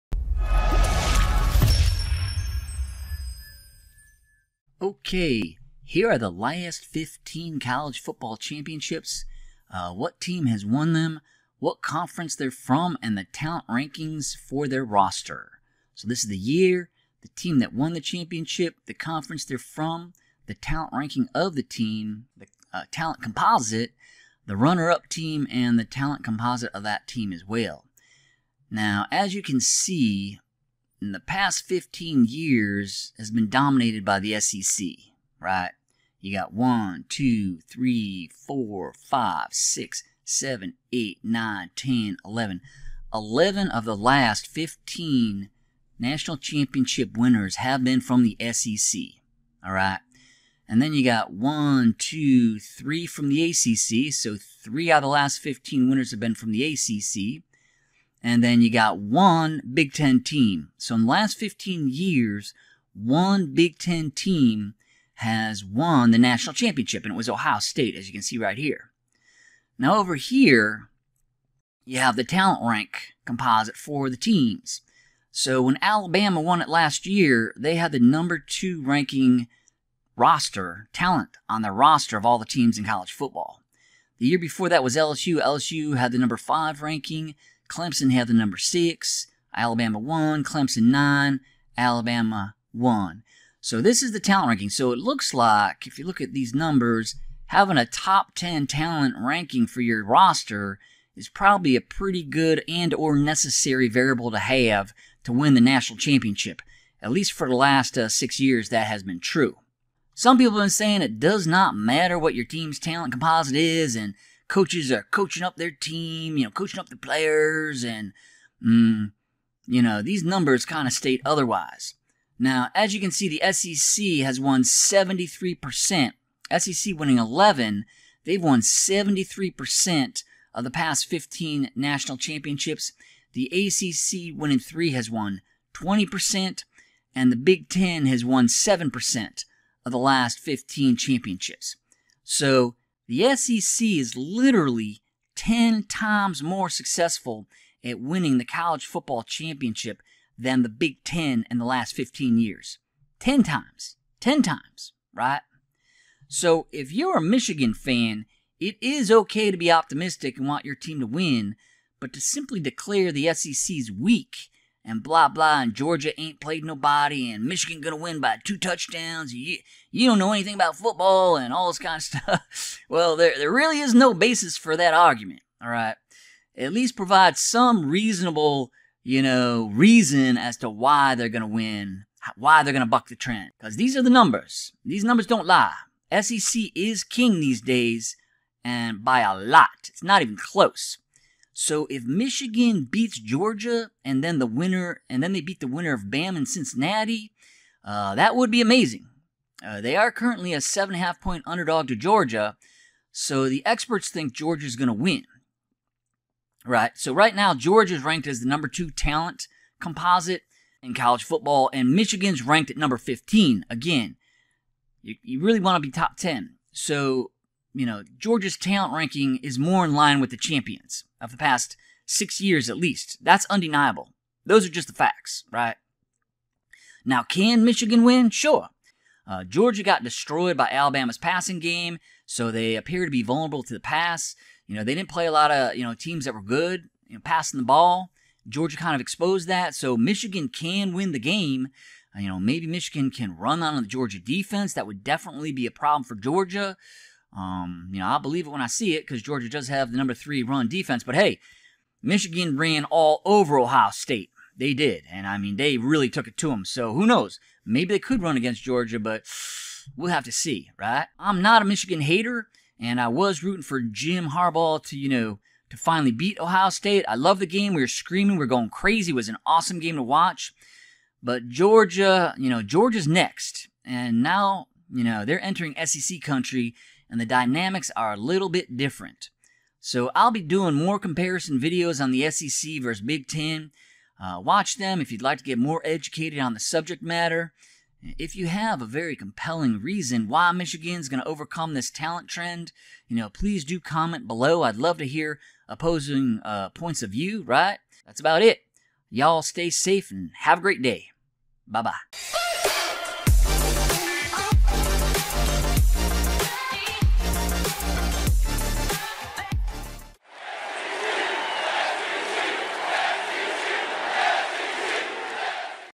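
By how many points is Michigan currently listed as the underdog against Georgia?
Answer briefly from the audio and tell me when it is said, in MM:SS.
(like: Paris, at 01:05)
7.5, at 03:20.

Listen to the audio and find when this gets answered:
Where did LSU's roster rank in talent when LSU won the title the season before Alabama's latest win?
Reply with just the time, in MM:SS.
01:26.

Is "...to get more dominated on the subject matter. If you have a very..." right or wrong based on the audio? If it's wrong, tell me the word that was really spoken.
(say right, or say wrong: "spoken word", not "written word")
wrong: "educated", not "dominated".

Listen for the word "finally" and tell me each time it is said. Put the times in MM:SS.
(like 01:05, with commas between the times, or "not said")
04:25.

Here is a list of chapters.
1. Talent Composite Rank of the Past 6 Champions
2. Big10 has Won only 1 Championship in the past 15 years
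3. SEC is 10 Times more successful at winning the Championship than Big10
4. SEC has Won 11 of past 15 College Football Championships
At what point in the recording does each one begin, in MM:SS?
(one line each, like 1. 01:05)
1. 01:10
2. 00:58
3. 02:25
4. 00:32.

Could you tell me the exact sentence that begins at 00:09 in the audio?
Uh, what team has won them, what conference they're from, and the talent rankings for their roster.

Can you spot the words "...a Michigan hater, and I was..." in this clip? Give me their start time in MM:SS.
04:21.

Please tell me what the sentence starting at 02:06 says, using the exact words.
SEC winning 11, they've won 73% of the past 15 national championships.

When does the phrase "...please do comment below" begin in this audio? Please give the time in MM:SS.
04:53.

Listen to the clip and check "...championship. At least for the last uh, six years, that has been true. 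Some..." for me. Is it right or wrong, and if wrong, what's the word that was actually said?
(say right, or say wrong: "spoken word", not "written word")
right.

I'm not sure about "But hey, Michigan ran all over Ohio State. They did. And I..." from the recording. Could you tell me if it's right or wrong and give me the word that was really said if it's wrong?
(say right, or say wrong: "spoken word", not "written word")
right.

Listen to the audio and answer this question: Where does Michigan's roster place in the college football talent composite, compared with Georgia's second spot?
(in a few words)
15.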